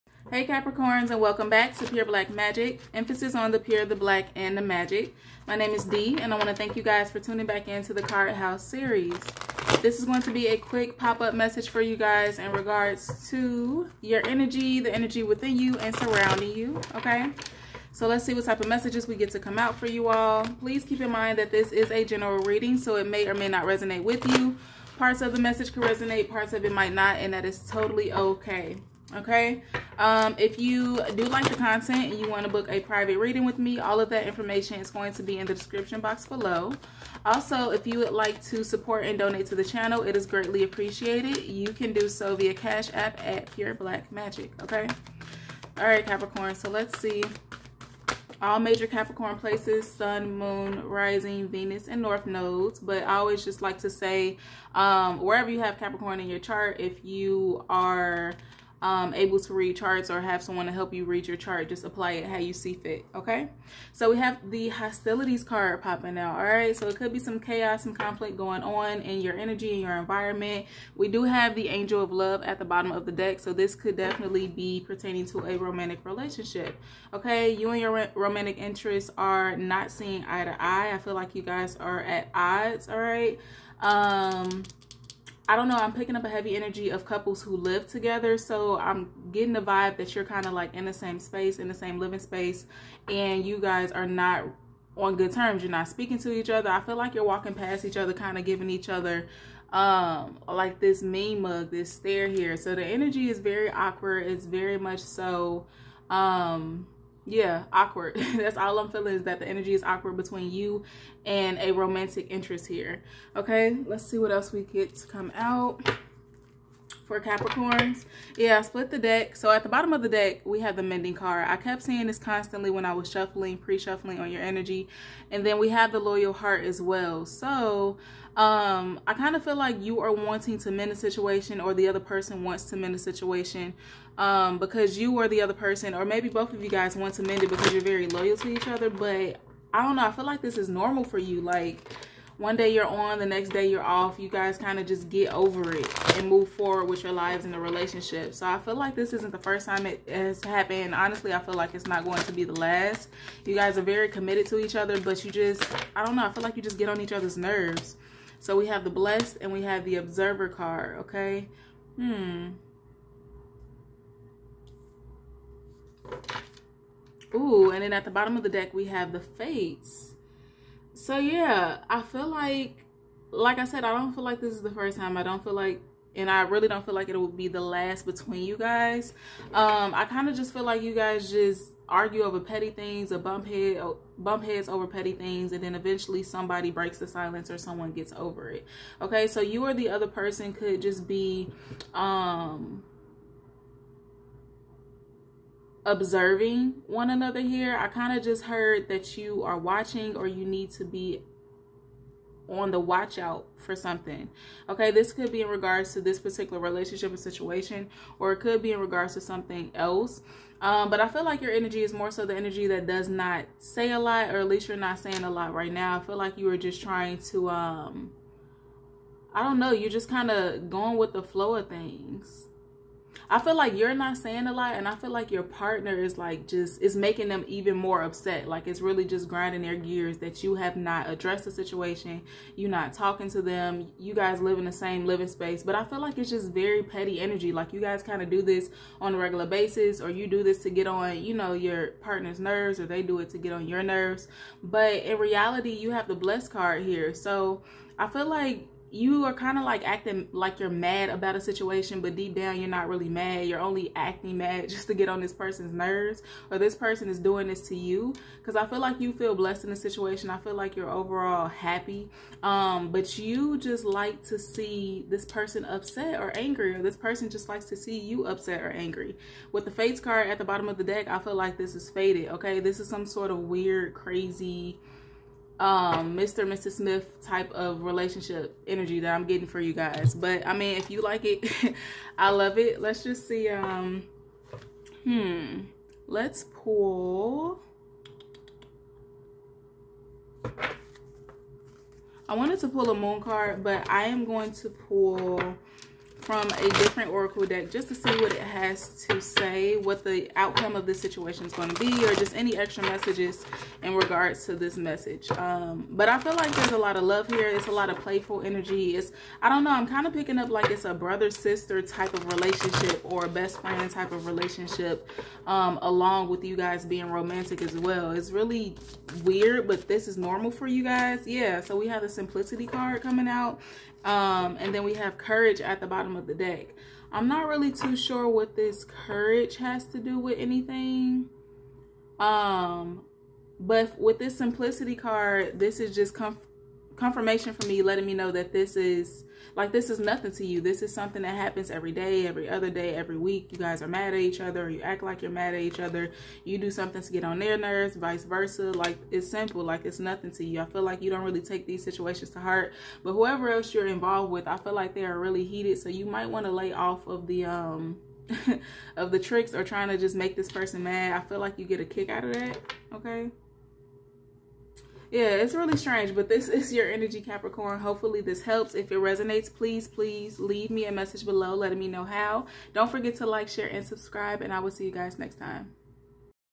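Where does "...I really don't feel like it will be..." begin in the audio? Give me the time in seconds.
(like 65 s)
176 s.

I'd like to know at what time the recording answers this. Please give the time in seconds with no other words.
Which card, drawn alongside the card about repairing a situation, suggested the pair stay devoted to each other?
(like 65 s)
125 s.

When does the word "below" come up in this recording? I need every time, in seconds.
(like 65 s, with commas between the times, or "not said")
36 s, 371 s.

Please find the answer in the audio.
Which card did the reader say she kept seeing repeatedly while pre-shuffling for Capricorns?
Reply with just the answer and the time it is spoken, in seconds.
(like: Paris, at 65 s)
Mending, at 120 s.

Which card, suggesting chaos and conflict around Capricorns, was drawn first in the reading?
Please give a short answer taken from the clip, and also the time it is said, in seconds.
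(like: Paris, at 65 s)
Hostilities, at 64 s.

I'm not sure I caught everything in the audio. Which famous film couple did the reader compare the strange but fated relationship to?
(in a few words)
Mr. and Mrs. Smith.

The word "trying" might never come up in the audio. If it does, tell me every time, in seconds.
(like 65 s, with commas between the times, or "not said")
216 s, 359 s.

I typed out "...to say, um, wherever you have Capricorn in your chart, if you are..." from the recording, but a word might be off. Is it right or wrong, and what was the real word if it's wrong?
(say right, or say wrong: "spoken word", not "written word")
right.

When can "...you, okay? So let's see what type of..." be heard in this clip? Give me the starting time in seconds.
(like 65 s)
16 s.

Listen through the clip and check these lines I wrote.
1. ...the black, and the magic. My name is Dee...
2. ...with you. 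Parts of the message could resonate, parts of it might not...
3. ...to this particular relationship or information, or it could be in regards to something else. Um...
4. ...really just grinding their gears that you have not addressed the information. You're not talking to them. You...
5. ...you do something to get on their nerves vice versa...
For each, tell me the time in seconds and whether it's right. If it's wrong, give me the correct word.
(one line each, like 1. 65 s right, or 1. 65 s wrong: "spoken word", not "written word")
1. 3 s right
2. 24 s right
3. 205 s wrong: "situation", not "information"
4. 228 s wrong: "situation", not "information"
5. 346 s right.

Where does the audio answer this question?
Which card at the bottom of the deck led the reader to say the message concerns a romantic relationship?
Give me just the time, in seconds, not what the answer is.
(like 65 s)
71 s.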